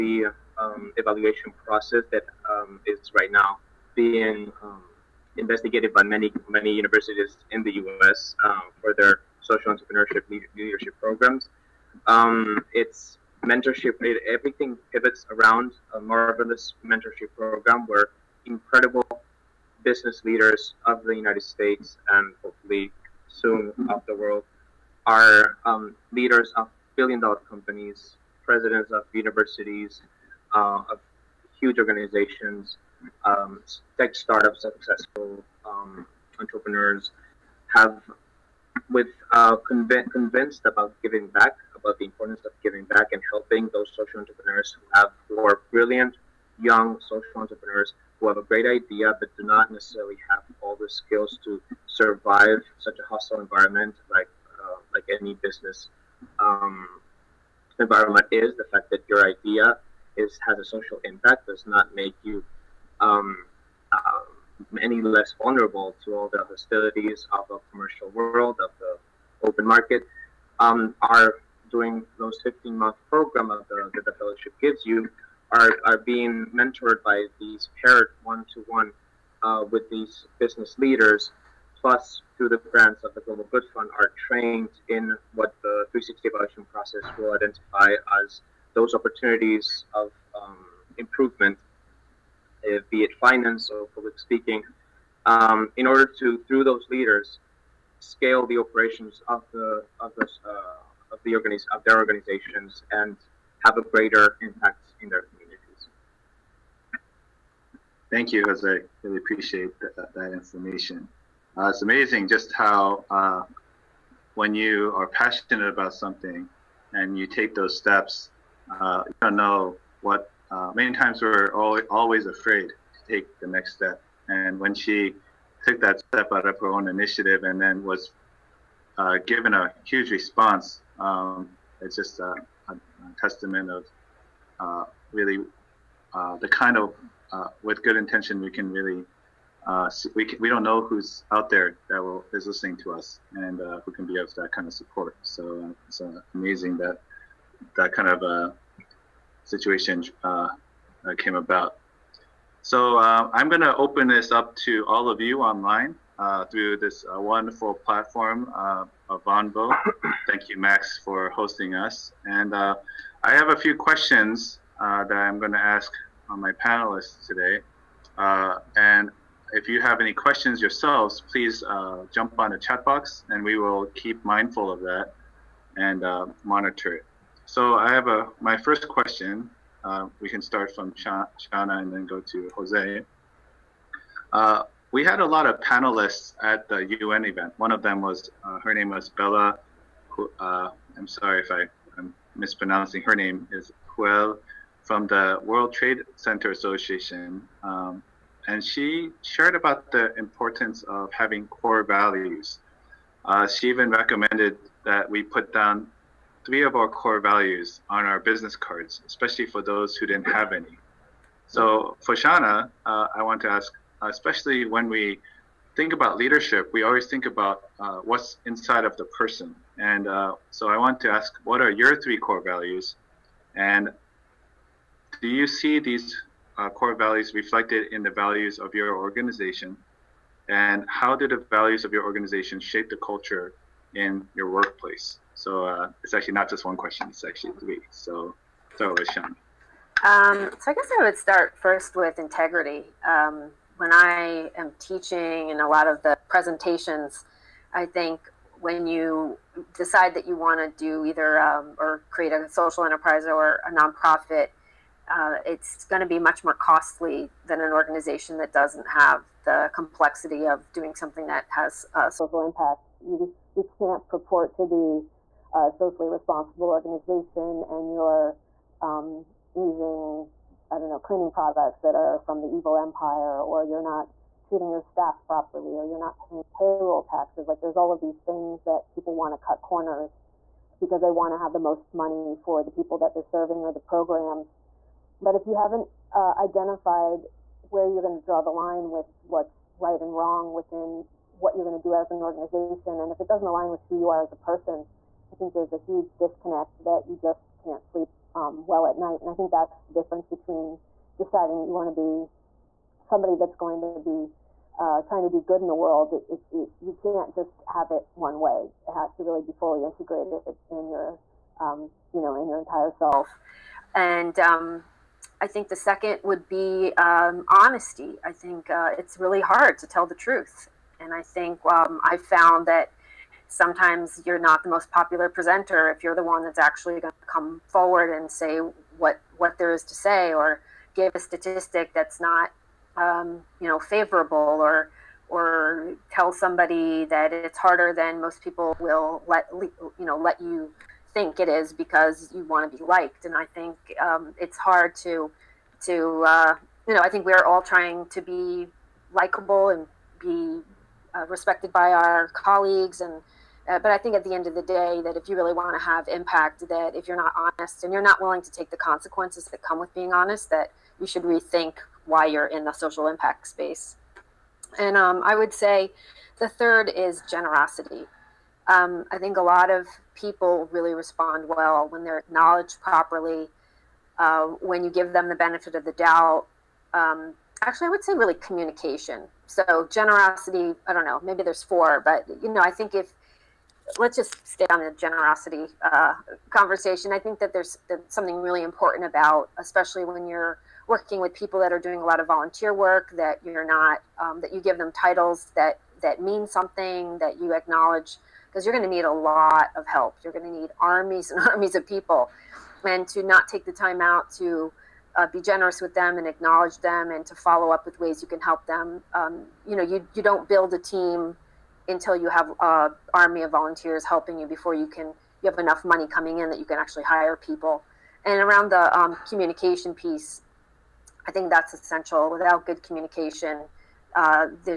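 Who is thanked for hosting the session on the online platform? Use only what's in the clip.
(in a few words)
Max.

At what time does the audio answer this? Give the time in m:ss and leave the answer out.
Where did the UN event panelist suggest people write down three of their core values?
3:28.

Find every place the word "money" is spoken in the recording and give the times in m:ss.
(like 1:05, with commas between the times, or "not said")
4:41, 6:55.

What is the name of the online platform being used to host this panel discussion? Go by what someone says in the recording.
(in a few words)
Vonvo.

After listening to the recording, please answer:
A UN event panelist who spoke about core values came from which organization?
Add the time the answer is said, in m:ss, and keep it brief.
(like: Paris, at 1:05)
World Trade Center Association, at 3:15.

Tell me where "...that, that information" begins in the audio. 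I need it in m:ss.
1:49.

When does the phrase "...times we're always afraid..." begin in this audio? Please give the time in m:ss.
2:00.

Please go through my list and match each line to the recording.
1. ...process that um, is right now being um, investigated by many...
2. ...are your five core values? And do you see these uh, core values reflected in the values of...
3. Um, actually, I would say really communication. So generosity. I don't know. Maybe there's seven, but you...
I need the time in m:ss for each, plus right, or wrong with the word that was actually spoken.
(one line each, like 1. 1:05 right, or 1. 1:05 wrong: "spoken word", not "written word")
1. 0:01 right
2. 3:41 wrong: "three", not "five"
3. 6:16 wrong: "four", not "seven".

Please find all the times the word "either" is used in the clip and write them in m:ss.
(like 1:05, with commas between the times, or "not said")
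4:11.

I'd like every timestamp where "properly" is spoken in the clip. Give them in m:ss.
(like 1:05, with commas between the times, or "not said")
4:35, 6:12.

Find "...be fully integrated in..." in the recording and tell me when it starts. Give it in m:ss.
5:09.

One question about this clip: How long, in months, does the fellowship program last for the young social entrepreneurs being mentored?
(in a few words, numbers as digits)
15 months.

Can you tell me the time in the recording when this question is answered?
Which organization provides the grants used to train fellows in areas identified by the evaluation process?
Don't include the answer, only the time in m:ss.
1:23.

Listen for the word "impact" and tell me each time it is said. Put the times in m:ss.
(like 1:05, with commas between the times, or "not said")
1:01, 1:44, 4:22, 5:56, 6:03.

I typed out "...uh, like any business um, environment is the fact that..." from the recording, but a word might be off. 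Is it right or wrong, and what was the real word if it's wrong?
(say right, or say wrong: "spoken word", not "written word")
right.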